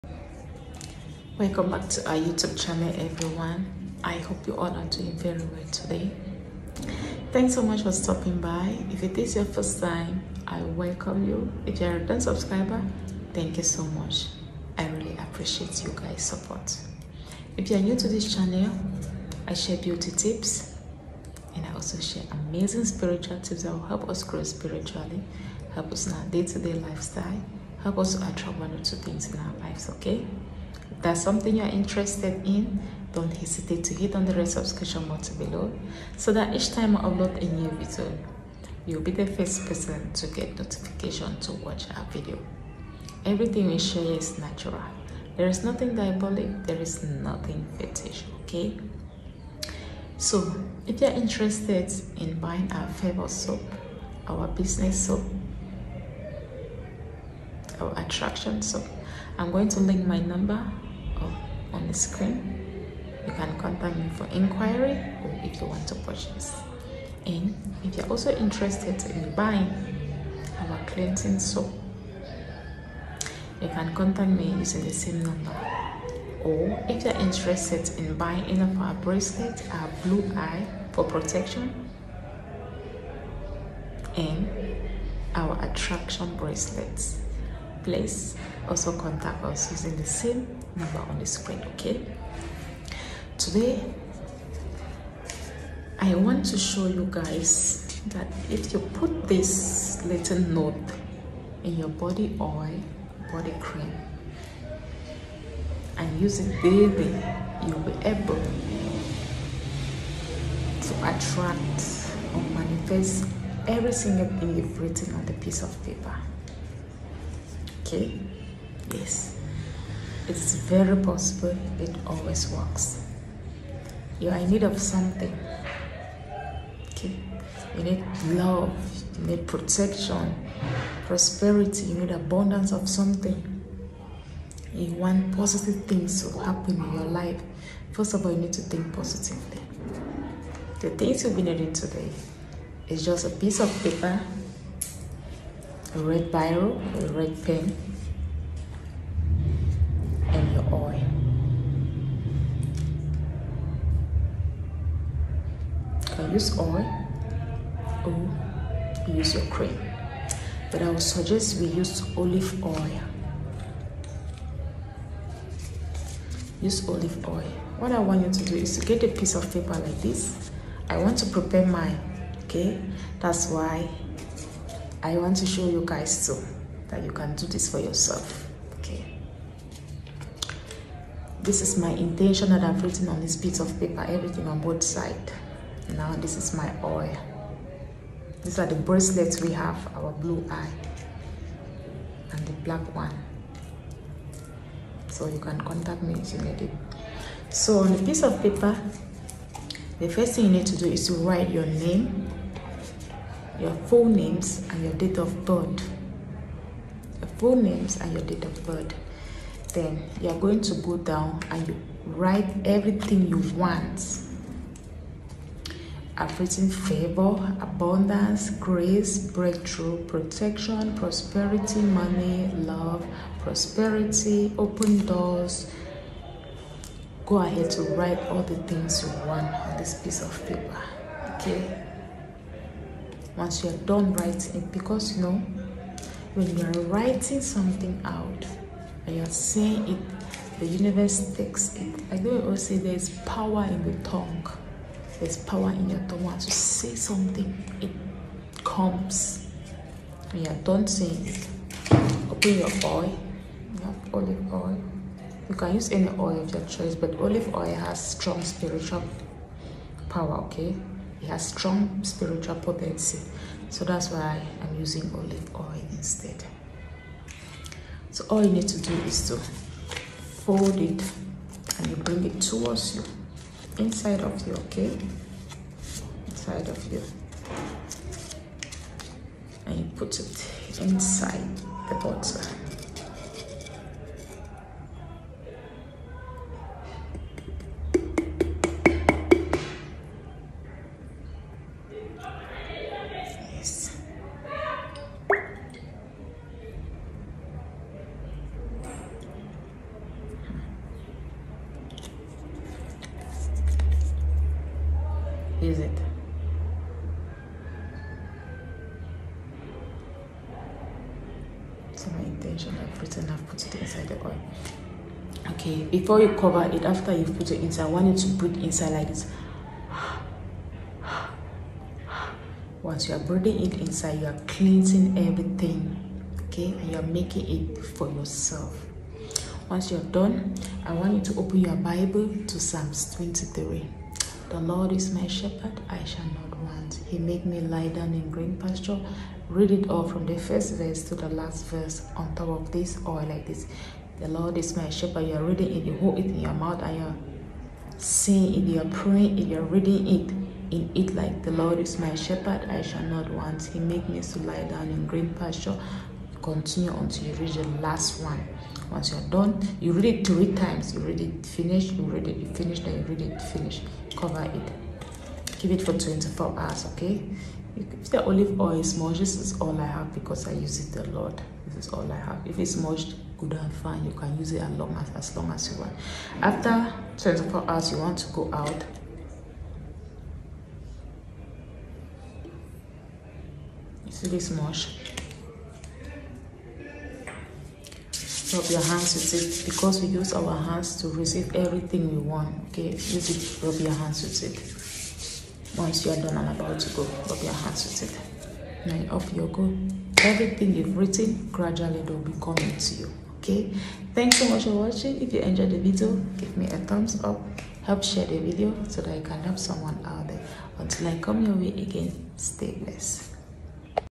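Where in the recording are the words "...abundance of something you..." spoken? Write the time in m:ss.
2:12.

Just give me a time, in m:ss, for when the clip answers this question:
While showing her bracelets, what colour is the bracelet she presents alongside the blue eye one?
3:12.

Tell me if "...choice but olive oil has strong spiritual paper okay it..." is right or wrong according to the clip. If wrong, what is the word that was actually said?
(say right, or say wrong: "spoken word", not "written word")
wrong: "power", not "paper".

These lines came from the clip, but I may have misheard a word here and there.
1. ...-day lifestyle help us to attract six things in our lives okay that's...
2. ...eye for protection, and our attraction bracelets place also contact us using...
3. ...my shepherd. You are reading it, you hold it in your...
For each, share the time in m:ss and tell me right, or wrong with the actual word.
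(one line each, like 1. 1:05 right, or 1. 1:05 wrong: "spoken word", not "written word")
1. 0:26 wrong: "two", not "six"
2. 1:20 right
3. 5:44 right.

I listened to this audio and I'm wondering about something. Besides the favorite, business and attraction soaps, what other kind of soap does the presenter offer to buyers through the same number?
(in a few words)
cleansing soap.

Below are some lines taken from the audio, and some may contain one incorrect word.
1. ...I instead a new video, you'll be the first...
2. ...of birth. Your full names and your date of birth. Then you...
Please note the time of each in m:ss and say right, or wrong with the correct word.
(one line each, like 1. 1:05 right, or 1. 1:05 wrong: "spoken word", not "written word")
1. 0:36 wrong: "upload", not "instead"
2. 3:25 right.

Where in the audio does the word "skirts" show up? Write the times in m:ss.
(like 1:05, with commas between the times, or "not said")
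not said.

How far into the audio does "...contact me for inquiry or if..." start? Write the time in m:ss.
1:03.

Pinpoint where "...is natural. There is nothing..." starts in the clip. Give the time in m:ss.
0:44.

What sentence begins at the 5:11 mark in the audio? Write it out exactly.
So my intention, I've written, I've put it inside the oil.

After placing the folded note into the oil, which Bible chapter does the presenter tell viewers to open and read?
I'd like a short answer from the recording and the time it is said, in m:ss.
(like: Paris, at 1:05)
Psalms 23, at 5:32.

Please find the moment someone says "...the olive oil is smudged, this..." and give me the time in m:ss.
6:08.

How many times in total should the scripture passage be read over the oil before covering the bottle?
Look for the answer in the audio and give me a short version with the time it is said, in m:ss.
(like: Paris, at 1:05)
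3 times, at 6:00.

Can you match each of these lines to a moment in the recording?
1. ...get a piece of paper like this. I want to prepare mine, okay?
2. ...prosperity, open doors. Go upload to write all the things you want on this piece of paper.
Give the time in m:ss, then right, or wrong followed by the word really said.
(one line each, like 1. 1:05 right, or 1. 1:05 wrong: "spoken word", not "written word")
1. 2:48 right
2. 3:43 wrong: "ahead", not "upload".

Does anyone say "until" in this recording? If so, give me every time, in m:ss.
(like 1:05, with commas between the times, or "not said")
5:56, 6:50.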